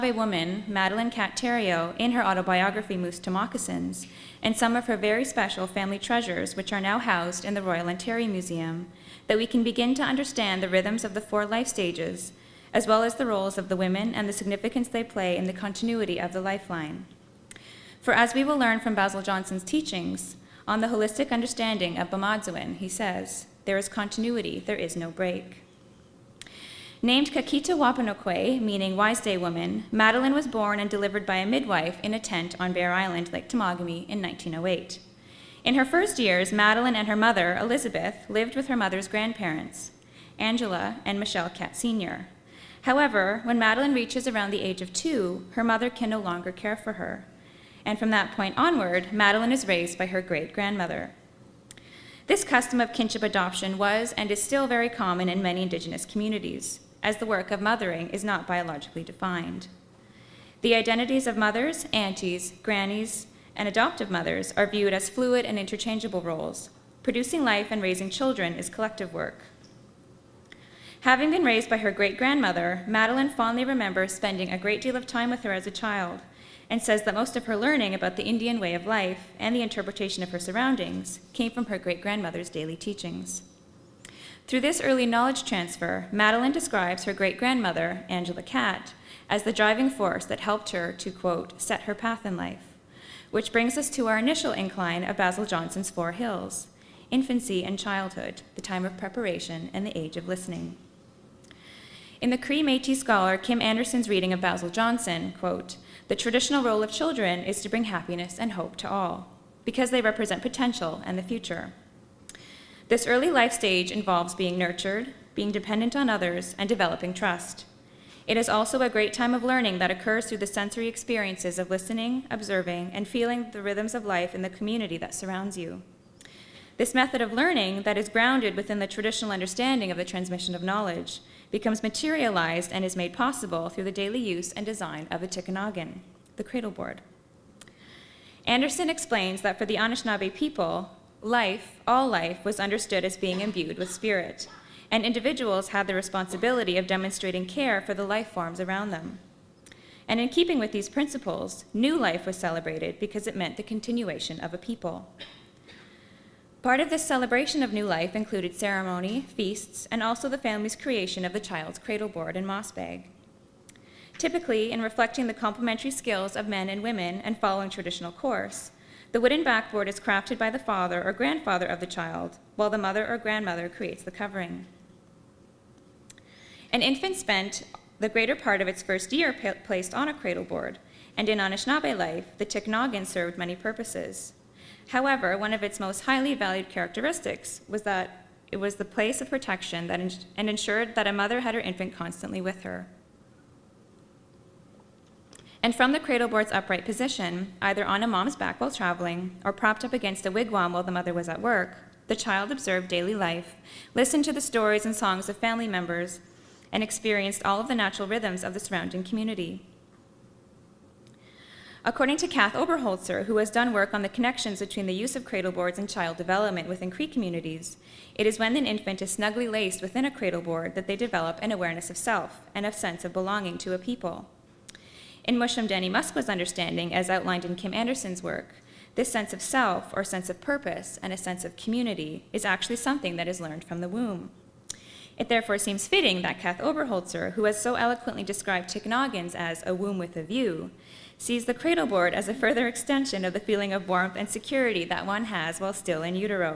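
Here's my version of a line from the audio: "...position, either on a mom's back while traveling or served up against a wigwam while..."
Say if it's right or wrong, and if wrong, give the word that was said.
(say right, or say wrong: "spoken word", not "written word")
wrong: "propped", not "served".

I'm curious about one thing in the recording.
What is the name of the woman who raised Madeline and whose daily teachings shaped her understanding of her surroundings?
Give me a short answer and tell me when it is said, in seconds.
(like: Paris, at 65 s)
Angela Katt, at 88 s.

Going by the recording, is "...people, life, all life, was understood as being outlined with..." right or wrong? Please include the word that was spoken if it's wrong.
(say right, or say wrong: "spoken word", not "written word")
wrong: "imbued", not "outlined".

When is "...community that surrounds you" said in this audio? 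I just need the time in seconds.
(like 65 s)
124 s.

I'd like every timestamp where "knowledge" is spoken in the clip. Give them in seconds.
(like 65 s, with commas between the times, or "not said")
85 s, 130 s.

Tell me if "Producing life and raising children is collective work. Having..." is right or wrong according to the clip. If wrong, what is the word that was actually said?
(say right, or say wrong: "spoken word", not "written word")
right.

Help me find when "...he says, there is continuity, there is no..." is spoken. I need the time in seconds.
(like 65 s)
22 s.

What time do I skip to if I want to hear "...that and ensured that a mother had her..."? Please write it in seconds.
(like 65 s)
189 s.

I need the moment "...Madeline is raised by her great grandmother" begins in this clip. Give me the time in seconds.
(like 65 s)
49 s.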